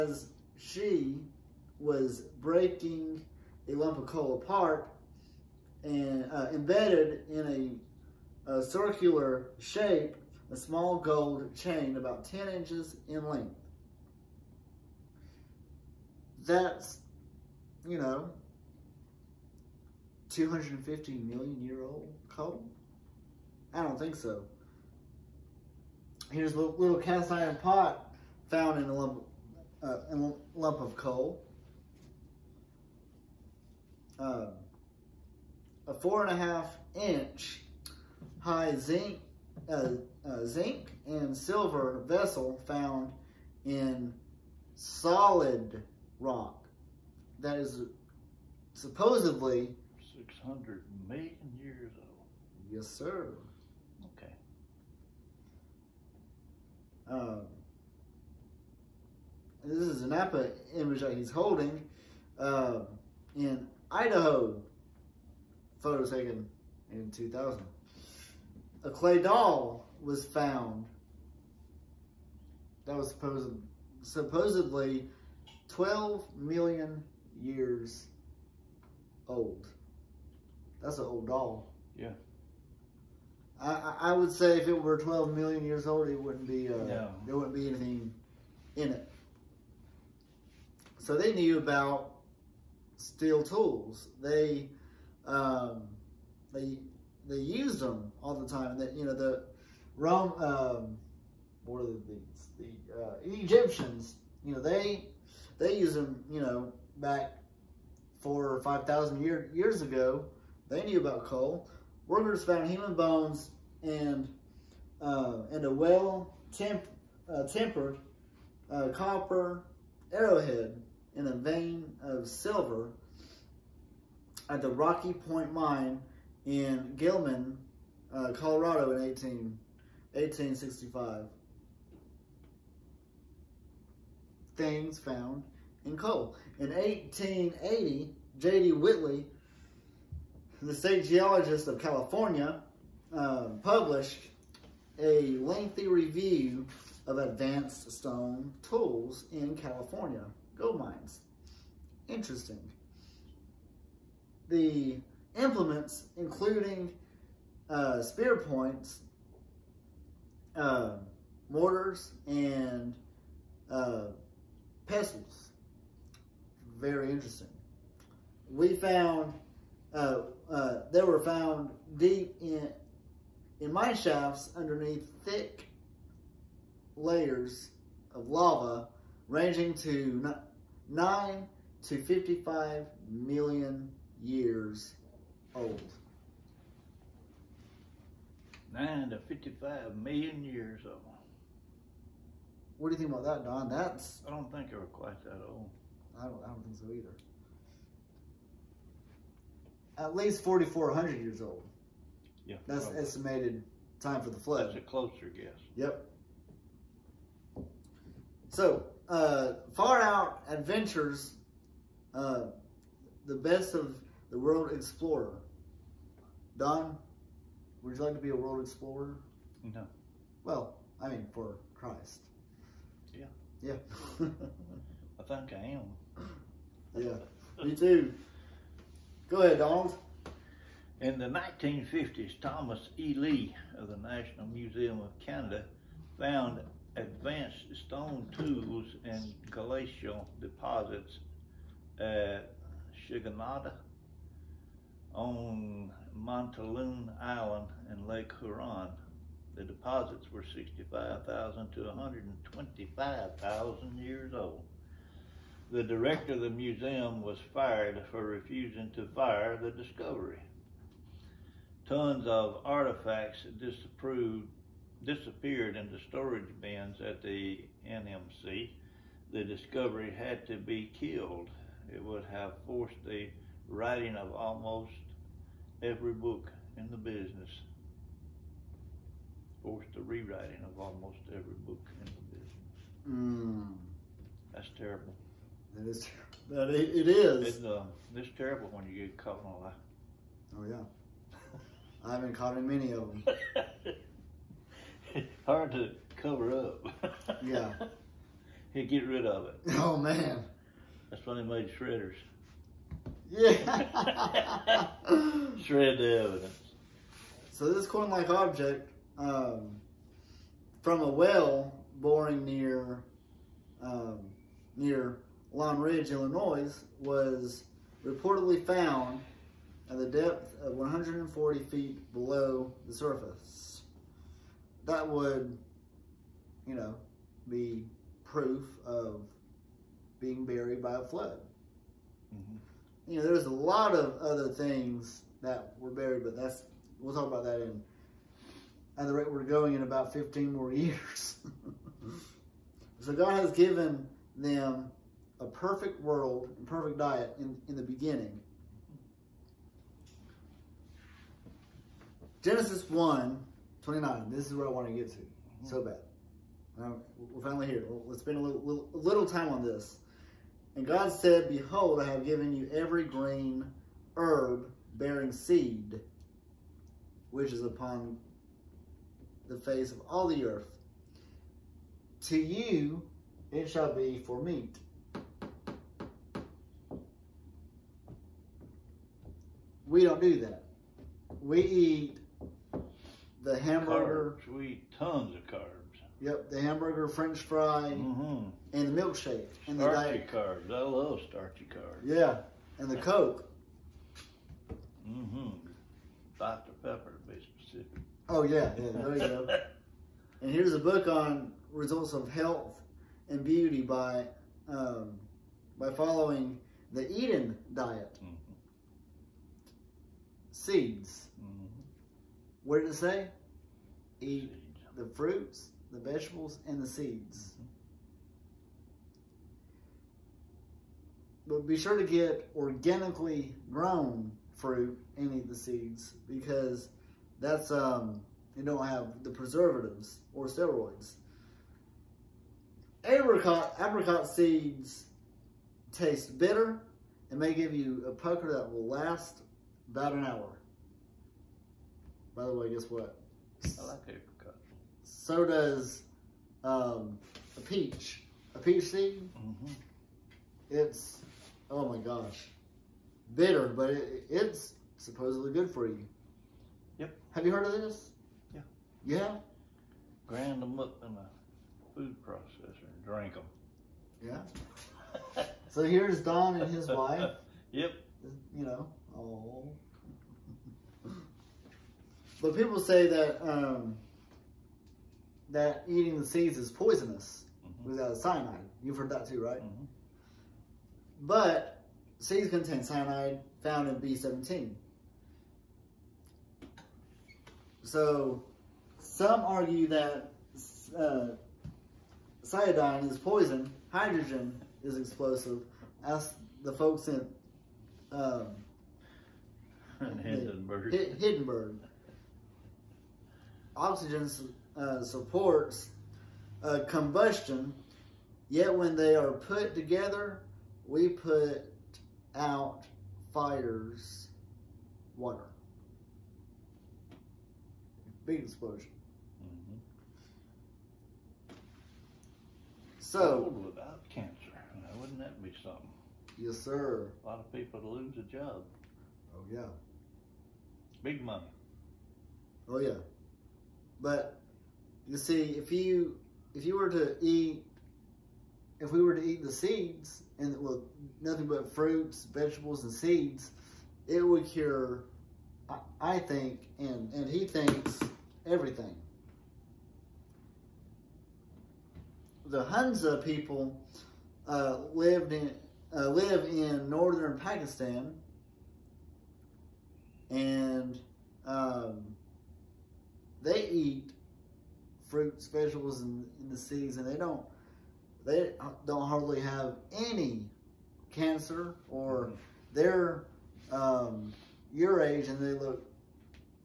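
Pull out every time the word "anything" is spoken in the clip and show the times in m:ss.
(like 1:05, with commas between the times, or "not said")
1:27.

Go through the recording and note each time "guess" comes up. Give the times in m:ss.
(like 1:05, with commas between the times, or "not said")
3:25, 7:22.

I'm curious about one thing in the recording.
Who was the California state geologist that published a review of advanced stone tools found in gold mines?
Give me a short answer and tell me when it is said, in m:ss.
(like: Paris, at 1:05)
J.D. Whitney, at 2:18.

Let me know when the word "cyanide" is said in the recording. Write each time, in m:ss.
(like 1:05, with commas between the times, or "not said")
7:58, 8:02.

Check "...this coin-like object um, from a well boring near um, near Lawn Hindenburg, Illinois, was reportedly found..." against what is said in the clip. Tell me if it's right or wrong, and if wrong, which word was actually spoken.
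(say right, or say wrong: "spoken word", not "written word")
wrong: "Ridge", not "Hindenburg".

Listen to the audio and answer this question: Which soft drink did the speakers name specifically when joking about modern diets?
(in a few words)
Dr. Pepper.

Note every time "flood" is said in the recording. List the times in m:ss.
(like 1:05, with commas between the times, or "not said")
3:24, 5:31.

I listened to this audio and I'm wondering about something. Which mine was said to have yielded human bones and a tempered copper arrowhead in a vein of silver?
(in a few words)
Rocky Point Mine.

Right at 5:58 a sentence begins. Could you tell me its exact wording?
Let's spend a little, little, little time on this.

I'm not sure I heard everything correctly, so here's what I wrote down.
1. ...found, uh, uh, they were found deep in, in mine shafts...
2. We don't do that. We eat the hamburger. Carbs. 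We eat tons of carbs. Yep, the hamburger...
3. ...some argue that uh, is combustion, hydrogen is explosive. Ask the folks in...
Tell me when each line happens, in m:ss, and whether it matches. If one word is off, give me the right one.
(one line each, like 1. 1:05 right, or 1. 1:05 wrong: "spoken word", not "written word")
1. 2:48 right
2. 6:19 right
3. 8:08 wrong: "poison", not "combustion".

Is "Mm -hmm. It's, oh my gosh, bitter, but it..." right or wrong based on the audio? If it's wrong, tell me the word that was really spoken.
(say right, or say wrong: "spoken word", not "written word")
right.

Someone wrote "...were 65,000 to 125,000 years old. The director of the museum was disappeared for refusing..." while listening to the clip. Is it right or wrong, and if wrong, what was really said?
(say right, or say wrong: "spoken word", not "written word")
wrong: "fired", not "disappeared".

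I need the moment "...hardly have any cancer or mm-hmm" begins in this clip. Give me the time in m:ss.
9:29.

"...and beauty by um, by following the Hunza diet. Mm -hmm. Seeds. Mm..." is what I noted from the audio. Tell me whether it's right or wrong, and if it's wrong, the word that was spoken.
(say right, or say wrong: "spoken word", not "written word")
wrong: "Eden", not "Hunza".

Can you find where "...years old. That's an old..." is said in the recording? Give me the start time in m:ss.
1:17.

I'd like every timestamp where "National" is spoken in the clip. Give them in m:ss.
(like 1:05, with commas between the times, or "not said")
3:53.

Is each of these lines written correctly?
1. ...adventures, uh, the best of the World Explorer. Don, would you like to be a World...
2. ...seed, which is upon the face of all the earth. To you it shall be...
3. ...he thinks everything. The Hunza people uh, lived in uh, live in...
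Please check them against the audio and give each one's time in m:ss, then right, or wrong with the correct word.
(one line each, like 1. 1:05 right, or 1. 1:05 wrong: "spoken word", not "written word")
1. 3:30 right
2. 6:05 right
3. 9:07 right.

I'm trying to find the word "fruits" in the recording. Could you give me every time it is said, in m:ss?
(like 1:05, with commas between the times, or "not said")
6:55, 7:04, 9:01, 9:25.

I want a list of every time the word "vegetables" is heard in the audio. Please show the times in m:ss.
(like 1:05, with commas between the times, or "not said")
6:56, 9:02.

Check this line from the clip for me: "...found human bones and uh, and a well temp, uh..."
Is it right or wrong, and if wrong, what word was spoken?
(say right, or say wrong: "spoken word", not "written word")
right.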